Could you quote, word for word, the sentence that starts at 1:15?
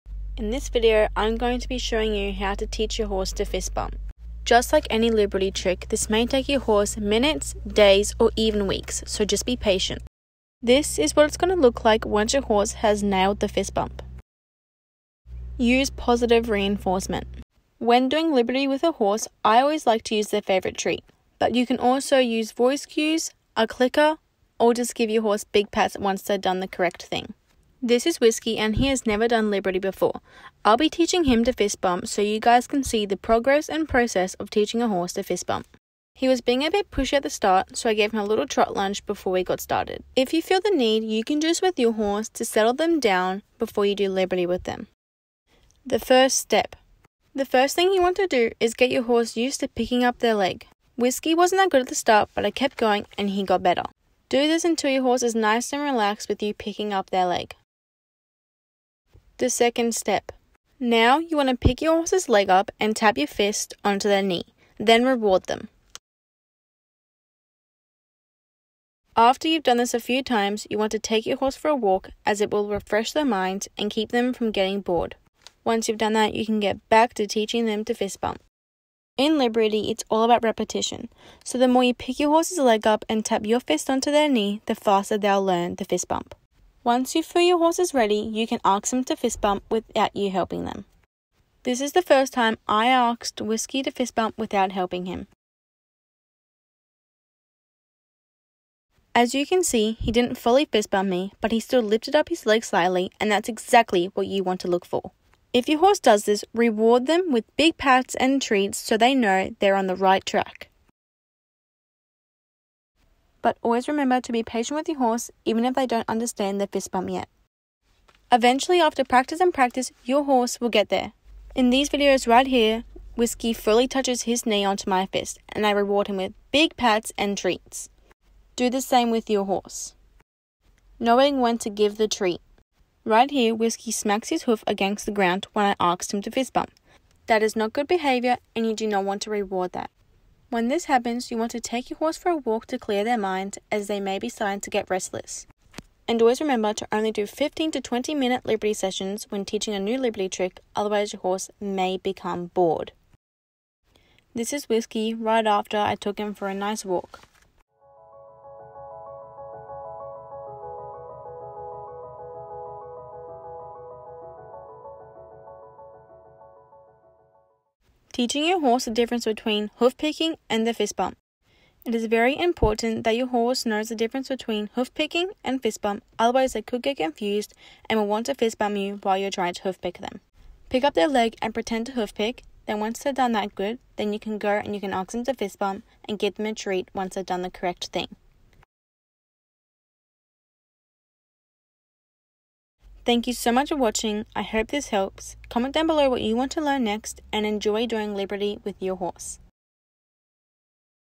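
Once you've done that, you can get back to teaching them to fist bump.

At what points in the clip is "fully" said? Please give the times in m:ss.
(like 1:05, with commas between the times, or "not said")
1:40, 2:03.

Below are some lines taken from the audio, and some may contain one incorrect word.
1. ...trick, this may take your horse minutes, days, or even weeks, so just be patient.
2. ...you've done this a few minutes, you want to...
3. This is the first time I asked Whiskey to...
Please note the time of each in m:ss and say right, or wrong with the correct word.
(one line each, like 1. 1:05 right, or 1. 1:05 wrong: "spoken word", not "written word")
1. 0:05 right
2. 1:09 wrong: "times", not "minutes"
3. 1:31 right.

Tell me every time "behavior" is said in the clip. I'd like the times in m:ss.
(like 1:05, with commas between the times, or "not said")
2:17.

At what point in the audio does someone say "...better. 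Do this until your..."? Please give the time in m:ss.
0:53.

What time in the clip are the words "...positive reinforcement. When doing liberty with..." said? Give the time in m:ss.
0:15.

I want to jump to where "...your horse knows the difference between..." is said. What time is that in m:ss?
2:53.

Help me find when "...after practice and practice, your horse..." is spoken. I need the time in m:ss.
1:58.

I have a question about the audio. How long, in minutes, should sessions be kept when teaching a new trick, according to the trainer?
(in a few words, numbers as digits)
15 to 20 minutes.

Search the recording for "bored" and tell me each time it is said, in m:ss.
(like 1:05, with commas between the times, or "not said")
1:14, 2:32.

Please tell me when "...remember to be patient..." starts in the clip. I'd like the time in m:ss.
1:53.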